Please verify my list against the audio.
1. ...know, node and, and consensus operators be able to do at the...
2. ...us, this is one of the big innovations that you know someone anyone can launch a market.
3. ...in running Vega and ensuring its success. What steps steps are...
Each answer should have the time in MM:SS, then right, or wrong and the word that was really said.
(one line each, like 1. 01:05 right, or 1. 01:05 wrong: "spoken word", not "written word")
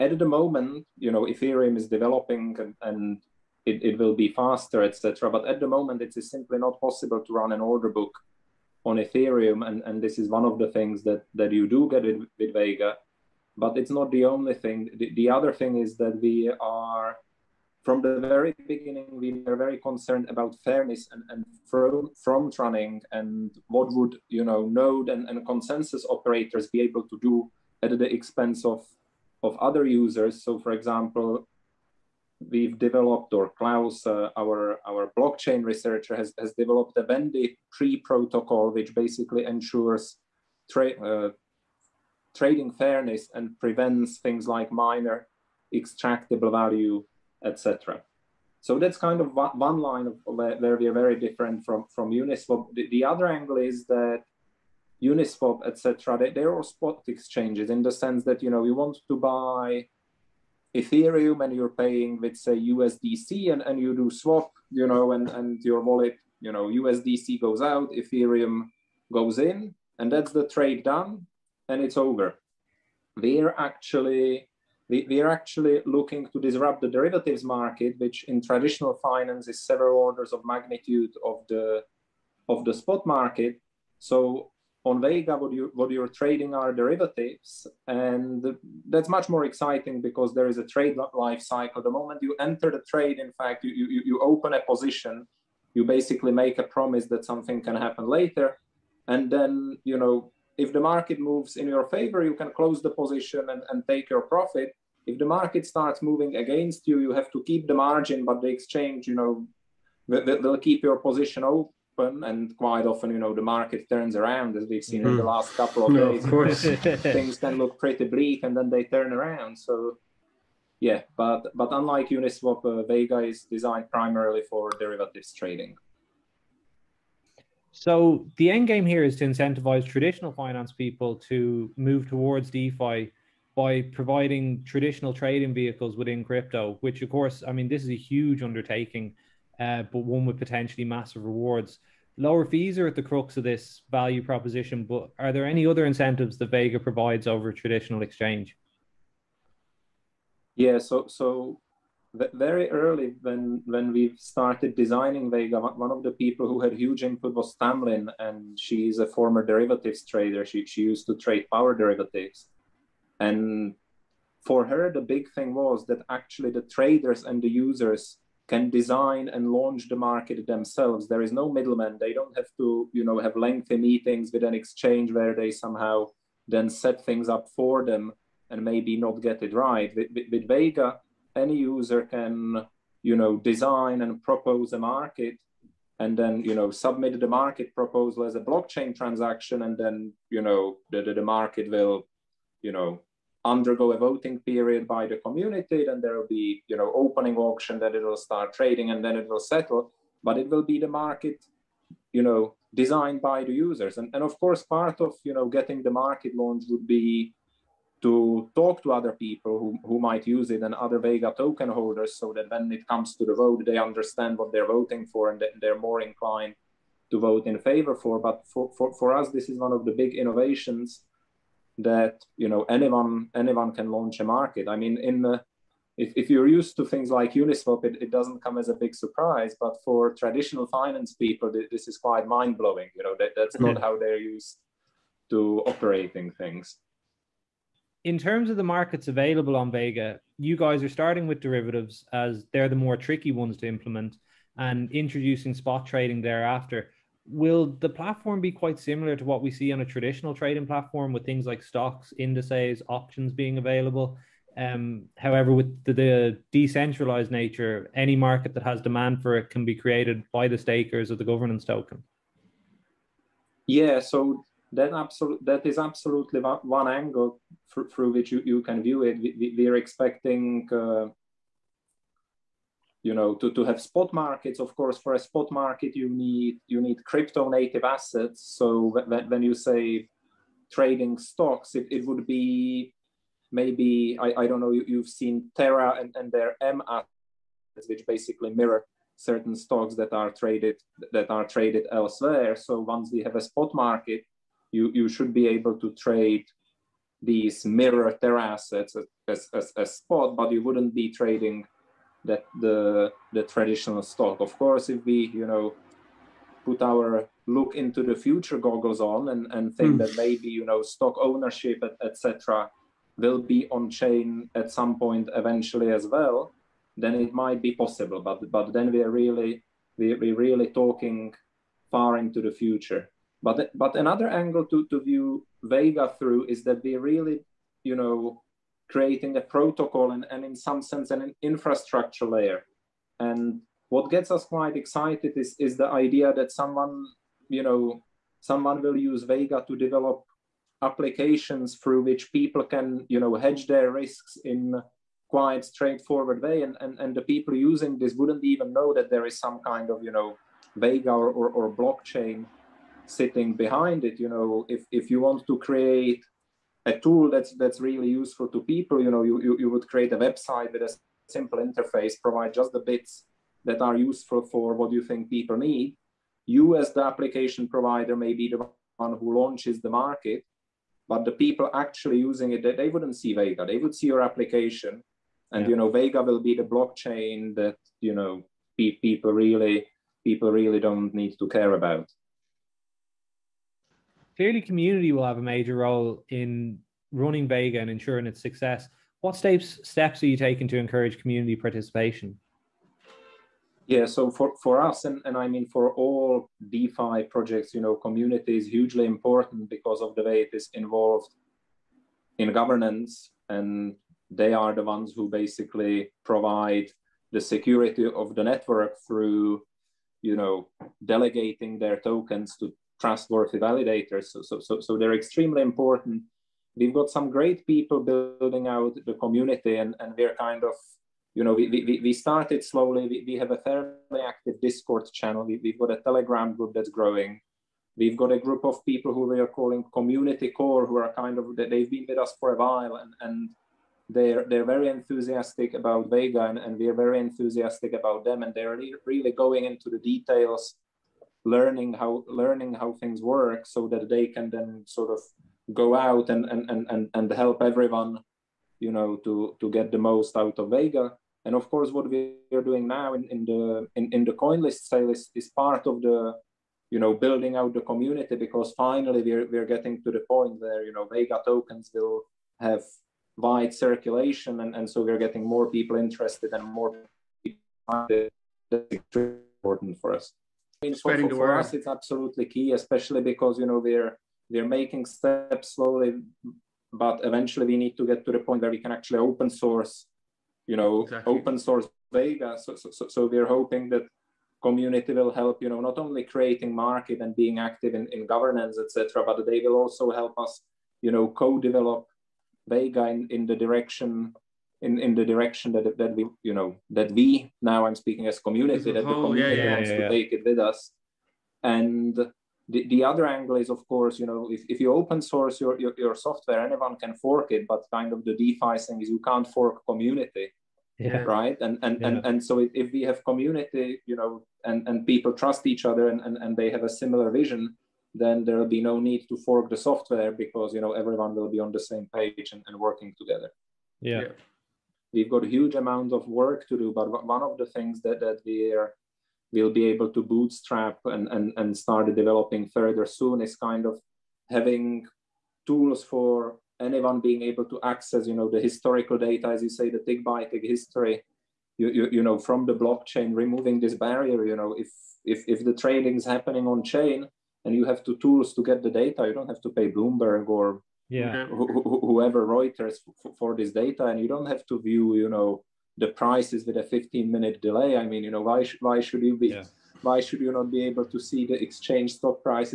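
1. 00:24 right
2. 03:39 wrong: "anyone", not "someone"
3. 06:26 right.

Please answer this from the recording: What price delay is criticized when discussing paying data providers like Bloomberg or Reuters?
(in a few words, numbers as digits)
15 minutes.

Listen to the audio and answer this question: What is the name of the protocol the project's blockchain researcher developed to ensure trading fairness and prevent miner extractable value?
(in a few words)
Bandit tree protocol.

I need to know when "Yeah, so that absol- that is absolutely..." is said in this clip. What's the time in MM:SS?
04:23.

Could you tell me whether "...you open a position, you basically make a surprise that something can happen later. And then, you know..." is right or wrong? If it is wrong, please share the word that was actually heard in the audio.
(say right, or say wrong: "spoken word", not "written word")
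wrong: "promise", not "surprise".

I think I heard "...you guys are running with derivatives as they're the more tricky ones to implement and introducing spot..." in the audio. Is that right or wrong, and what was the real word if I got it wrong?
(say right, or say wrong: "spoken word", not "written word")
wrong: "starting", not "running".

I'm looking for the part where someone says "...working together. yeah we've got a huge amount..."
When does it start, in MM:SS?
08:42.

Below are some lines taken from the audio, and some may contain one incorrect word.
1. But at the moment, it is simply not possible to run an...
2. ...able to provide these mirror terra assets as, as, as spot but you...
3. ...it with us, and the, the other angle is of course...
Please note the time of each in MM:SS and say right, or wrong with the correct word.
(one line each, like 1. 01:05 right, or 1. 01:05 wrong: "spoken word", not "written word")
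1. 00:05 right
2. 04:55 wrong: "trade", not "provide"
3. 08:20 right.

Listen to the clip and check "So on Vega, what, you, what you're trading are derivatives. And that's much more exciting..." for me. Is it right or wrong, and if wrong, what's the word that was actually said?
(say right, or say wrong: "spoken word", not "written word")
right.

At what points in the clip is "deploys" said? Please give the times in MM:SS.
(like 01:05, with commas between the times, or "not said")
not said.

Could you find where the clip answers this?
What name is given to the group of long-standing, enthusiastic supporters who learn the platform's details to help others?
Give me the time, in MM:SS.
07:09.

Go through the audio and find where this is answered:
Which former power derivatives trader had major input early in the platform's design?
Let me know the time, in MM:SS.
02:37.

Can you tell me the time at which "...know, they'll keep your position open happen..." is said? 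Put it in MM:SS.
01:49.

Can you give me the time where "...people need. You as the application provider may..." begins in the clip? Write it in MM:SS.
06:05.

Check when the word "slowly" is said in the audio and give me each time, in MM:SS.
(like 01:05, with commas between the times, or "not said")
07:02, 07:55.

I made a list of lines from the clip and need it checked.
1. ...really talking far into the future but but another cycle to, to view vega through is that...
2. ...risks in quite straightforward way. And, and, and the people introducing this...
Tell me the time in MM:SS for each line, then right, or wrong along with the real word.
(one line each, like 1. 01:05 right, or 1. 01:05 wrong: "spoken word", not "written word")
1. 05:20 wrong: "angle", not "cycle"
2. 05:43 wrong: "using", not "introducing".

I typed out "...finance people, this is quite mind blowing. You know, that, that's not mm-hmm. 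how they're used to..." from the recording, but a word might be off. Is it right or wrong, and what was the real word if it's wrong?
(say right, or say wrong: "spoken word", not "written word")
right.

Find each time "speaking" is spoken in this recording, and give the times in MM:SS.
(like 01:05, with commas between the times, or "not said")
08:17.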